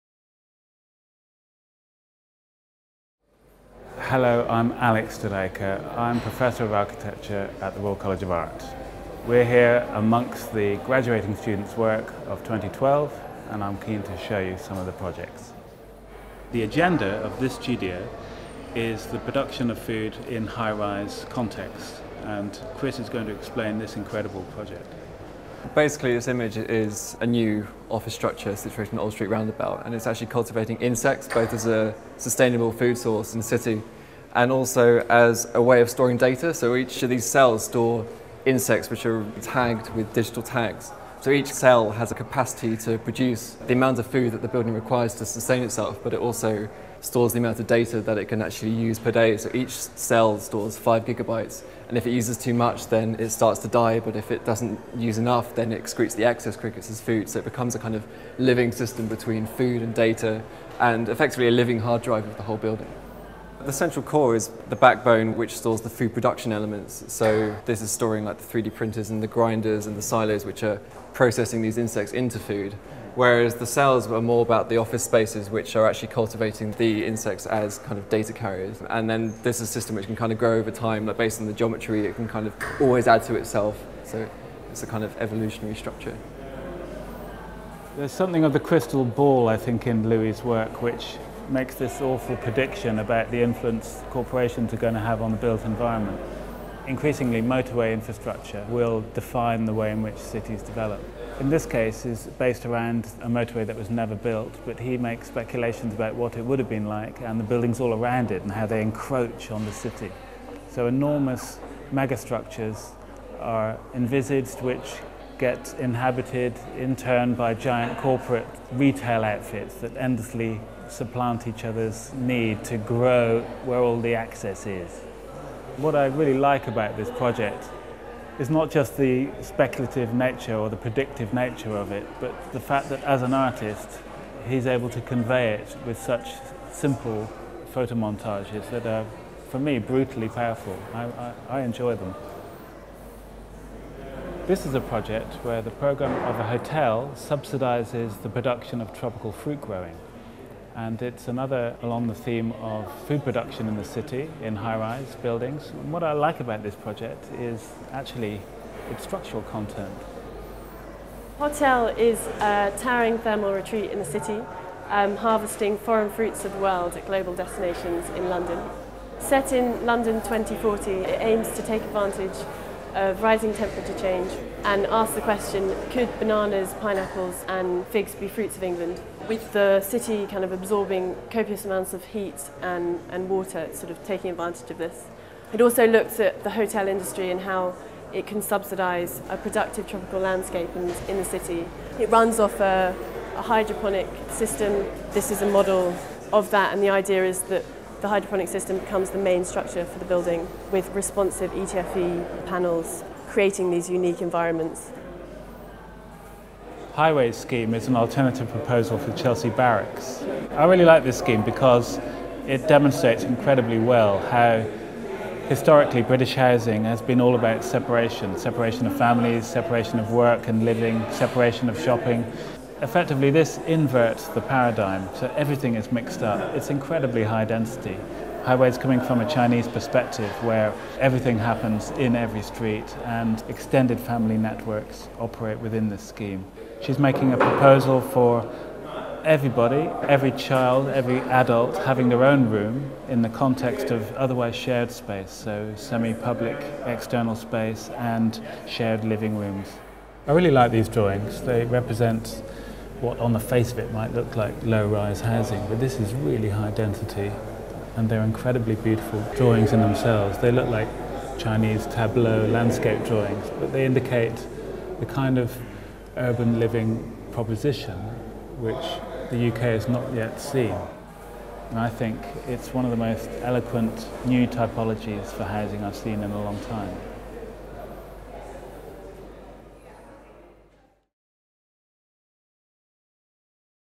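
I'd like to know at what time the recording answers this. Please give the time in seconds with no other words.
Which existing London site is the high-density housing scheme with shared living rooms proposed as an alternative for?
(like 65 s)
209 s.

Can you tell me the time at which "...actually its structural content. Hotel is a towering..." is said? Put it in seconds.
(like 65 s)
157 s.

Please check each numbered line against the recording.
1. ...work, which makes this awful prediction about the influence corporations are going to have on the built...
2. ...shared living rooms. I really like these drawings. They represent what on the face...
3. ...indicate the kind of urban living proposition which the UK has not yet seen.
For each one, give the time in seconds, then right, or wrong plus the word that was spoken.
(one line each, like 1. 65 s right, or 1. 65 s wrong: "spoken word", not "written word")
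1. 90 s right
2. 248 s right
3. 263 s right.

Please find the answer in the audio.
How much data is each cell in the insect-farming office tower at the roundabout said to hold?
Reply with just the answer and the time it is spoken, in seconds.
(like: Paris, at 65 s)
5 gigabytes, at 50 s.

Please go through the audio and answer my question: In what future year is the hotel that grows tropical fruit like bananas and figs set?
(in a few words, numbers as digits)
2040.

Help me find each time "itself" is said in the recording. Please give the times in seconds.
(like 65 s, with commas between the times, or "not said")
45 s, 83 s.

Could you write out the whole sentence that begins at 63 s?
The central core is the backbone which stores the food production elements.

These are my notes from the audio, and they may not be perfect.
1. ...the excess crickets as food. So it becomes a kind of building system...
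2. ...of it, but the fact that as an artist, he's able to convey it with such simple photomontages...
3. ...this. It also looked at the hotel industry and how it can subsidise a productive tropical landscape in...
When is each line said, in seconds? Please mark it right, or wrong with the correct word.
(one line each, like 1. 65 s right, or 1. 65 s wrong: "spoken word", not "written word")
1. 56 s wrong: "living", not "building"
2. 131 s right
3. 184 s right.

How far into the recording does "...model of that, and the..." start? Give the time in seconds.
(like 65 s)
195 s.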